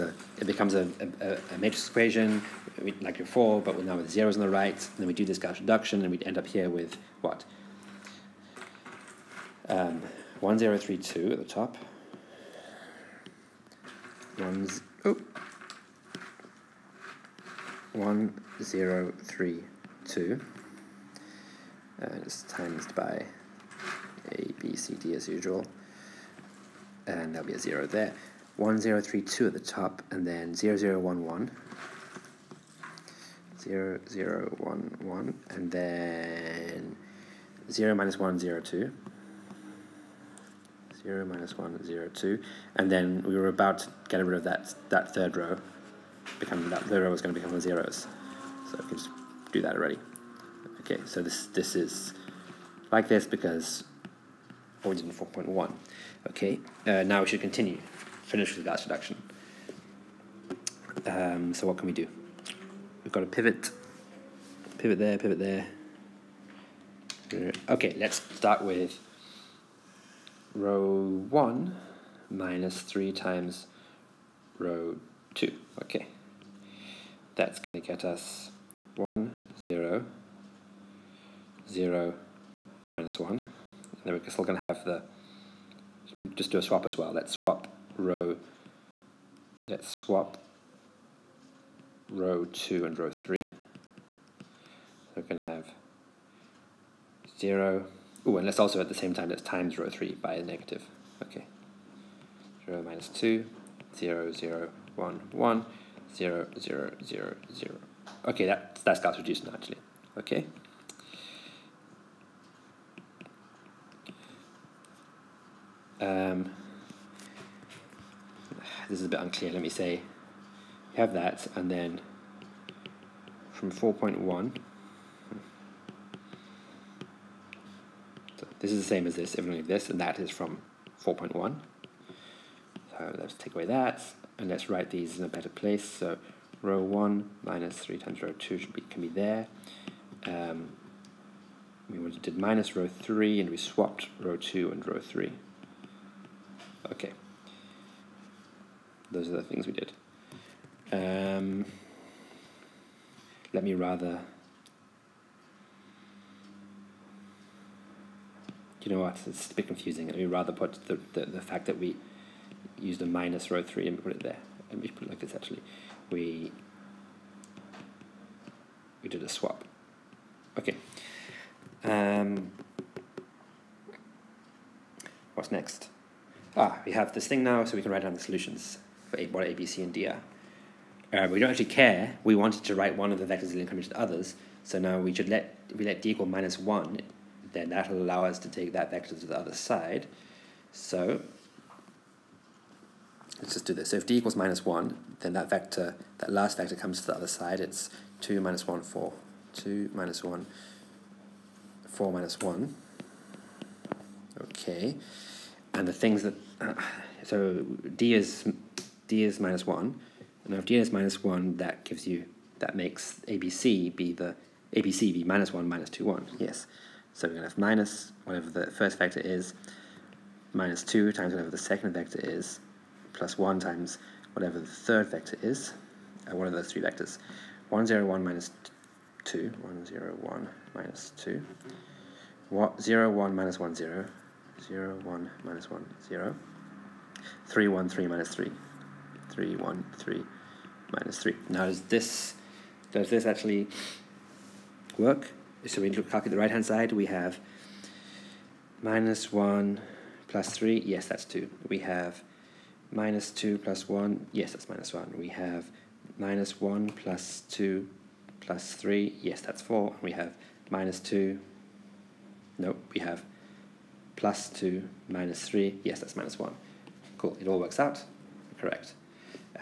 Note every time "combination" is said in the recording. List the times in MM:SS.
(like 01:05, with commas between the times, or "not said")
03:03.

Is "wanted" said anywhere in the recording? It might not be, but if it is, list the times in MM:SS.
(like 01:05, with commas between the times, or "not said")
03:02.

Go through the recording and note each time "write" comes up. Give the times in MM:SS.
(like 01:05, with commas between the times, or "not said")
02:14, 02:57, 03:02.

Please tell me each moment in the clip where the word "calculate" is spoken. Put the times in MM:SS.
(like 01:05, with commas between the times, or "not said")
04:06.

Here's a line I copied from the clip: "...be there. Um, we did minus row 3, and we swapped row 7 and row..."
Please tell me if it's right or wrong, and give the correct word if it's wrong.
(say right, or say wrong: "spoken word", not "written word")
wrong: "2", not "7".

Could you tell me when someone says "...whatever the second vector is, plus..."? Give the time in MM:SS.
03:41.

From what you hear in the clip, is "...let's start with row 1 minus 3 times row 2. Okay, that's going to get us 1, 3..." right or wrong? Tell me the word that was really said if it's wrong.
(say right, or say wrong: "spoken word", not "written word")
wrong: "0", not "3".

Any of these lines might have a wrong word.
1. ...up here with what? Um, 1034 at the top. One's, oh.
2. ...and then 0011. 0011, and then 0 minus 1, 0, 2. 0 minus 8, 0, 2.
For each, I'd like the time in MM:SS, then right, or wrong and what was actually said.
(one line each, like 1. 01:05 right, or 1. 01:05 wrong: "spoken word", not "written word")
1. 00:06 wrong: "1032", not "1034"
2. 00:30 wrong: "1", not "8".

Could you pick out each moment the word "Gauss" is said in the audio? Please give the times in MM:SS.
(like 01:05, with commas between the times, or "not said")
00:05.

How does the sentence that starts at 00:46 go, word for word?
Become, that third row was going to become the zeros.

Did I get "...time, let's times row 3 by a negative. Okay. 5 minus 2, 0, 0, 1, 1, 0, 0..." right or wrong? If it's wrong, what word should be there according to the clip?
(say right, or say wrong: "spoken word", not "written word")
wrong: "0", not "5".